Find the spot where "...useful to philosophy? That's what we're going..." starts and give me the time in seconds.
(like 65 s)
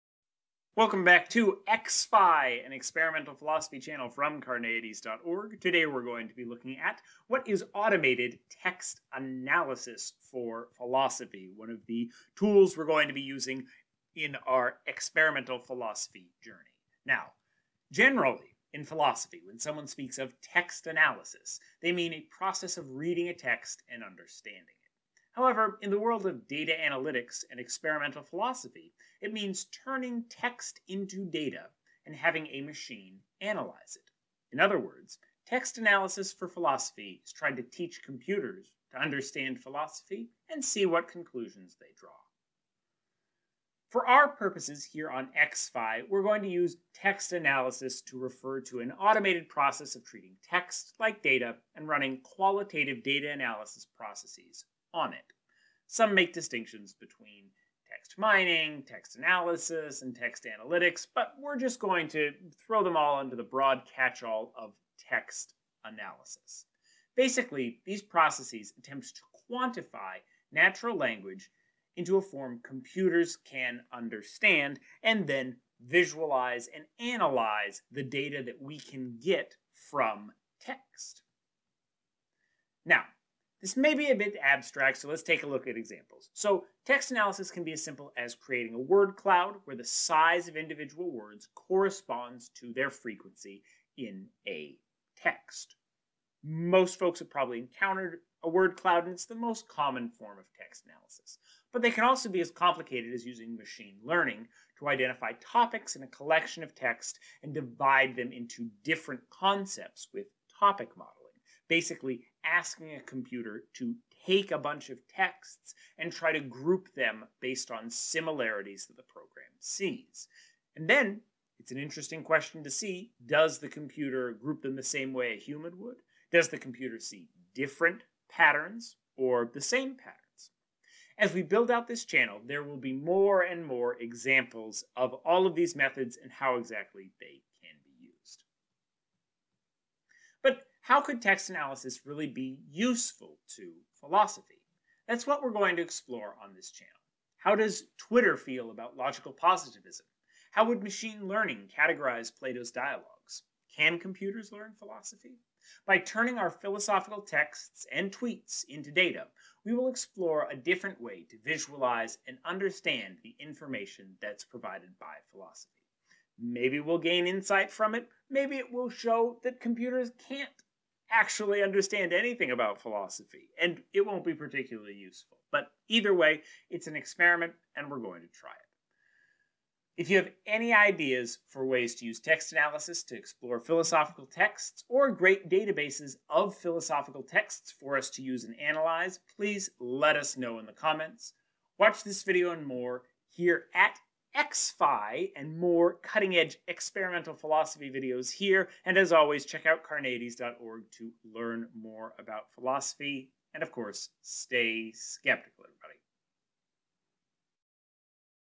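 142 s.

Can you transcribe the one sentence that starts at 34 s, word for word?
In other words, text analysis for philosophy is trying to teach computers to understand philosophy and see what conclusions they draw.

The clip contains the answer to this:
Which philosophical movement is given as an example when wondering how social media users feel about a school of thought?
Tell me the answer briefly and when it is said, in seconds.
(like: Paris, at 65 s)
logical positivism, at 148 s.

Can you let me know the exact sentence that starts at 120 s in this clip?
And then it's an interesting question to see does the computer group them the same way a human would?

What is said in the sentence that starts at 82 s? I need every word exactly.
Now, this may be a bit abstract, so let's take a look at examples.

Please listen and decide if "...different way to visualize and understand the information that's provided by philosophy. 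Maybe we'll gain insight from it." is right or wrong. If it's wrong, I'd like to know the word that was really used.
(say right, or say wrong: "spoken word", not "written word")
right.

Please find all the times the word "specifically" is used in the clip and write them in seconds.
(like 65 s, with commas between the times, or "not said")
not said.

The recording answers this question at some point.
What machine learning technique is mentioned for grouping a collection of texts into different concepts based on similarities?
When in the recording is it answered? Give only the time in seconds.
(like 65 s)
110 s.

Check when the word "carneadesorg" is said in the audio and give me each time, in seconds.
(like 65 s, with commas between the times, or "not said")
4 s, 199 s.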